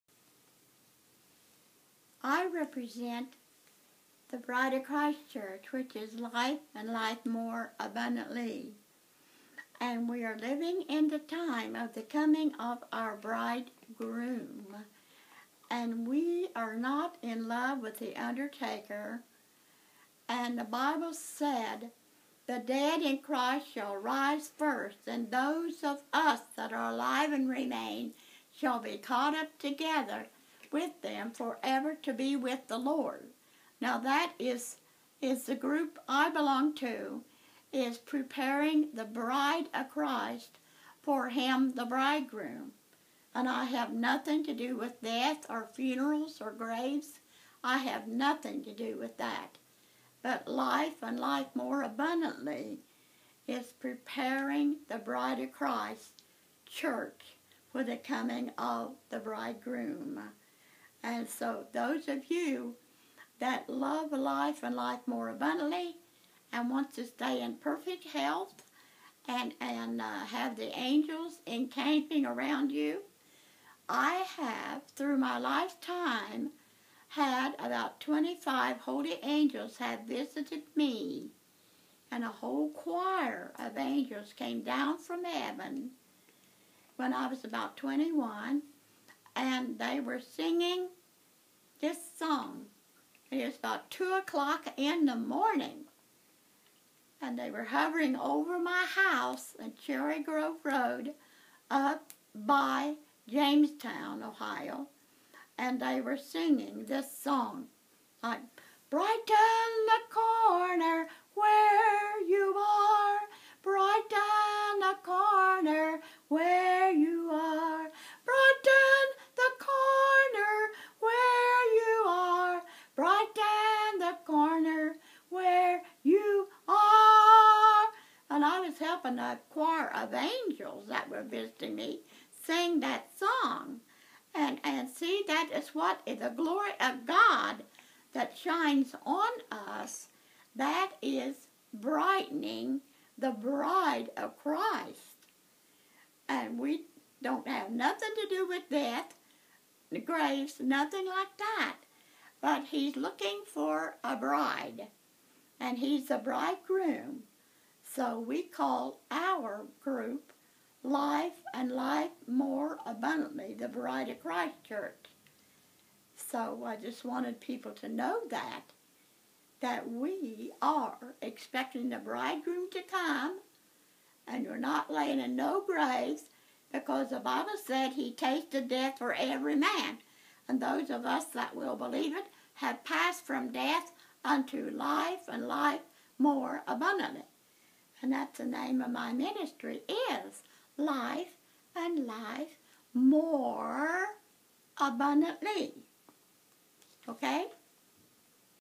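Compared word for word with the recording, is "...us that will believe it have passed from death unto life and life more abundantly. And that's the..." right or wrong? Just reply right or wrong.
right.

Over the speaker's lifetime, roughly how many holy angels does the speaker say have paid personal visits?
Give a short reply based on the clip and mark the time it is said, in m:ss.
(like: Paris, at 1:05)
25, at 1:17.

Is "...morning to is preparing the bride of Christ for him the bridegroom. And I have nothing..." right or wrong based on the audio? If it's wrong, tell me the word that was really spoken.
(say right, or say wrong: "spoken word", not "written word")
wrong: "belong", not "morning".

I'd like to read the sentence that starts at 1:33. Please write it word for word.
It was about 2 o'clock in the morning.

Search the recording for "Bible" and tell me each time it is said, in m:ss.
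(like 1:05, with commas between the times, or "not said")
0:20, 2:57.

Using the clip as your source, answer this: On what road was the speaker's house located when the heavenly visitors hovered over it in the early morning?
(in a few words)
Cherry Grove Road.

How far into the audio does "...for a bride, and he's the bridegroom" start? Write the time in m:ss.
2:33.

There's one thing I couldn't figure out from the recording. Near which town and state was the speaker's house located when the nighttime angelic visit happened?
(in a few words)
Jamestown, Ohio.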